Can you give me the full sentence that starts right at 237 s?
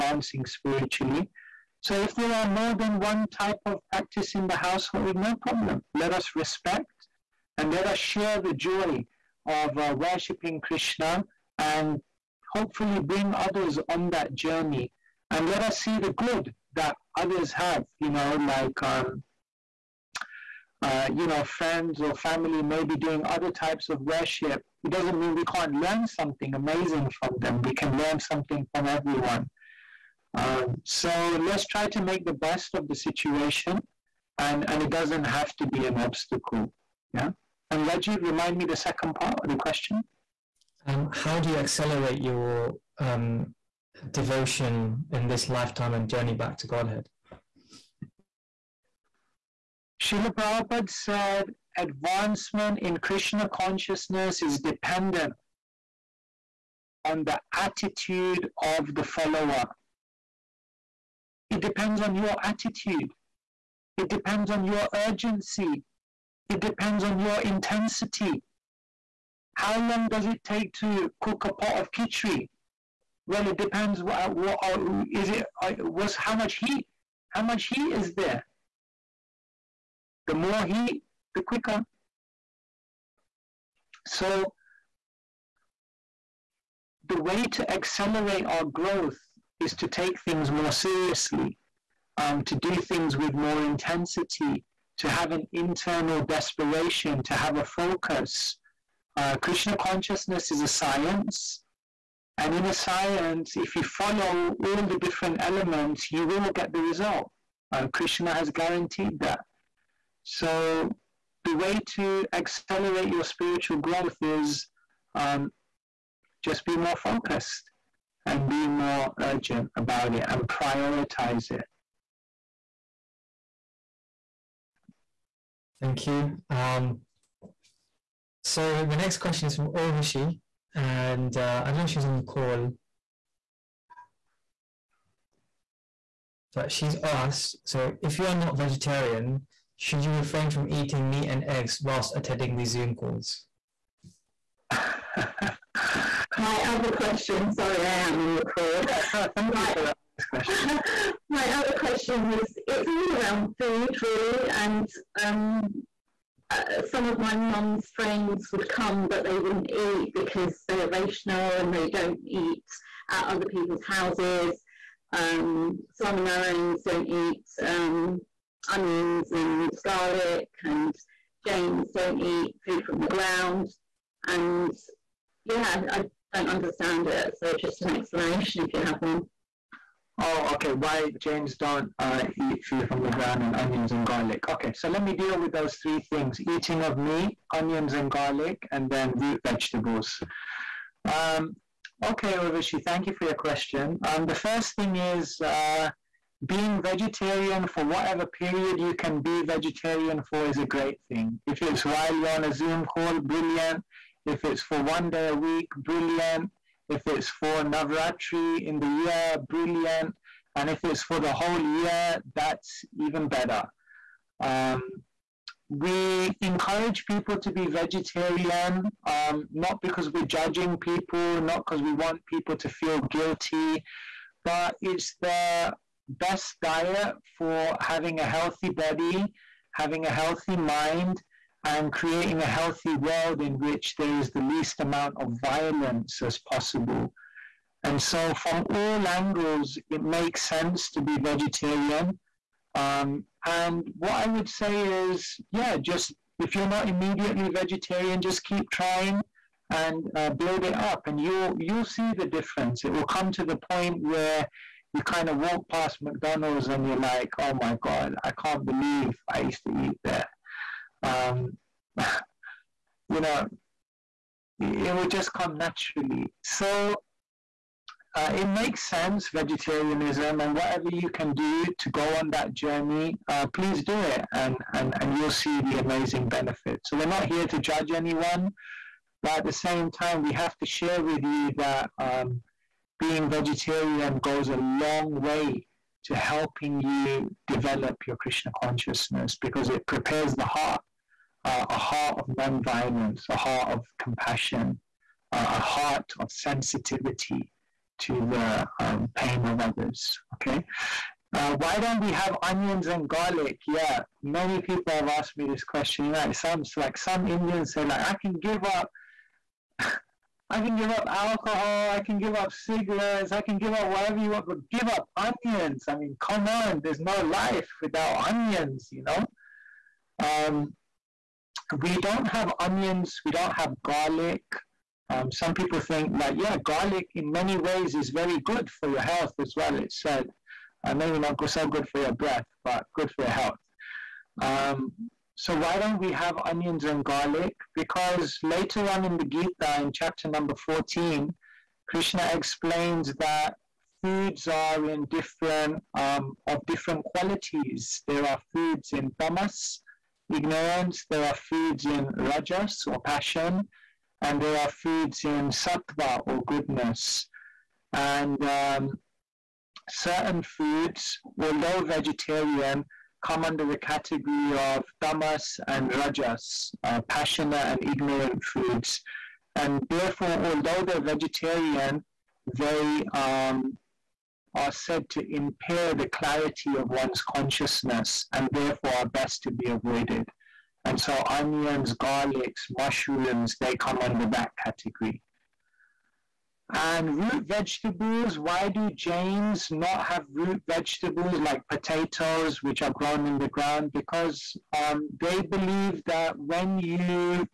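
And so, from all angles, it makes sense to be vegetarian.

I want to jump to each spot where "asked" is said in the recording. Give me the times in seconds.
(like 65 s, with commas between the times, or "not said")
137 s, 305 s.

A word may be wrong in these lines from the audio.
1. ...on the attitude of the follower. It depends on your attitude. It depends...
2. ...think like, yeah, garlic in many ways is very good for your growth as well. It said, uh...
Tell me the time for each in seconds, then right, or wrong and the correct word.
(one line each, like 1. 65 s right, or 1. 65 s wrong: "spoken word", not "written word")
1. 57 s right
2. 325 s wrong: "health", not "growth".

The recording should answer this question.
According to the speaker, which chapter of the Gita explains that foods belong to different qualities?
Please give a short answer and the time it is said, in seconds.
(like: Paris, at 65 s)
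14, at 340 s.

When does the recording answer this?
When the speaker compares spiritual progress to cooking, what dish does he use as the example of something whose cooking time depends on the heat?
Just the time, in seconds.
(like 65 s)
71 s.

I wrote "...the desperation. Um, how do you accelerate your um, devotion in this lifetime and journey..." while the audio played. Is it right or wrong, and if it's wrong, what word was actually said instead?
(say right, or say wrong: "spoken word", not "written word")
wrong: "question", not "desperation".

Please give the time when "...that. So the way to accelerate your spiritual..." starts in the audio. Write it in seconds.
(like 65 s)
109 s.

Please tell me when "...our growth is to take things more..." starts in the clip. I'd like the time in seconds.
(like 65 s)
88 s.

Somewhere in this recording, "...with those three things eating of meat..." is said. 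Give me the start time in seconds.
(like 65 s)
185 s.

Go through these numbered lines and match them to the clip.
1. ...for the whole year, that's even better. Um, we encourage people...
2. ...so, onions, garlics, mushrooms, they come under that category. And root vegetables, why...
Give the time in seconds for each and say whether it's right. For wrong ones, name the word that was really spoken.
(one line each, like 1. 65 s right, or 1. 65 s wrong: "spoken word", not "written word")
1. 211 s right
2. 380 s right.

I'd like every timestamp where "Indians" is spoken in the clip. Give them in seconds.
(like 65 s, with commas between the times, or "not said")
307 s.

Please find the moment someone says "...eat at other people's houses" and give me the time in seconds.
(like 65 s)
162 s.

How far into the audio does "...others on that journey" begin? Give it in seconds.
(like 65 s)
13 s.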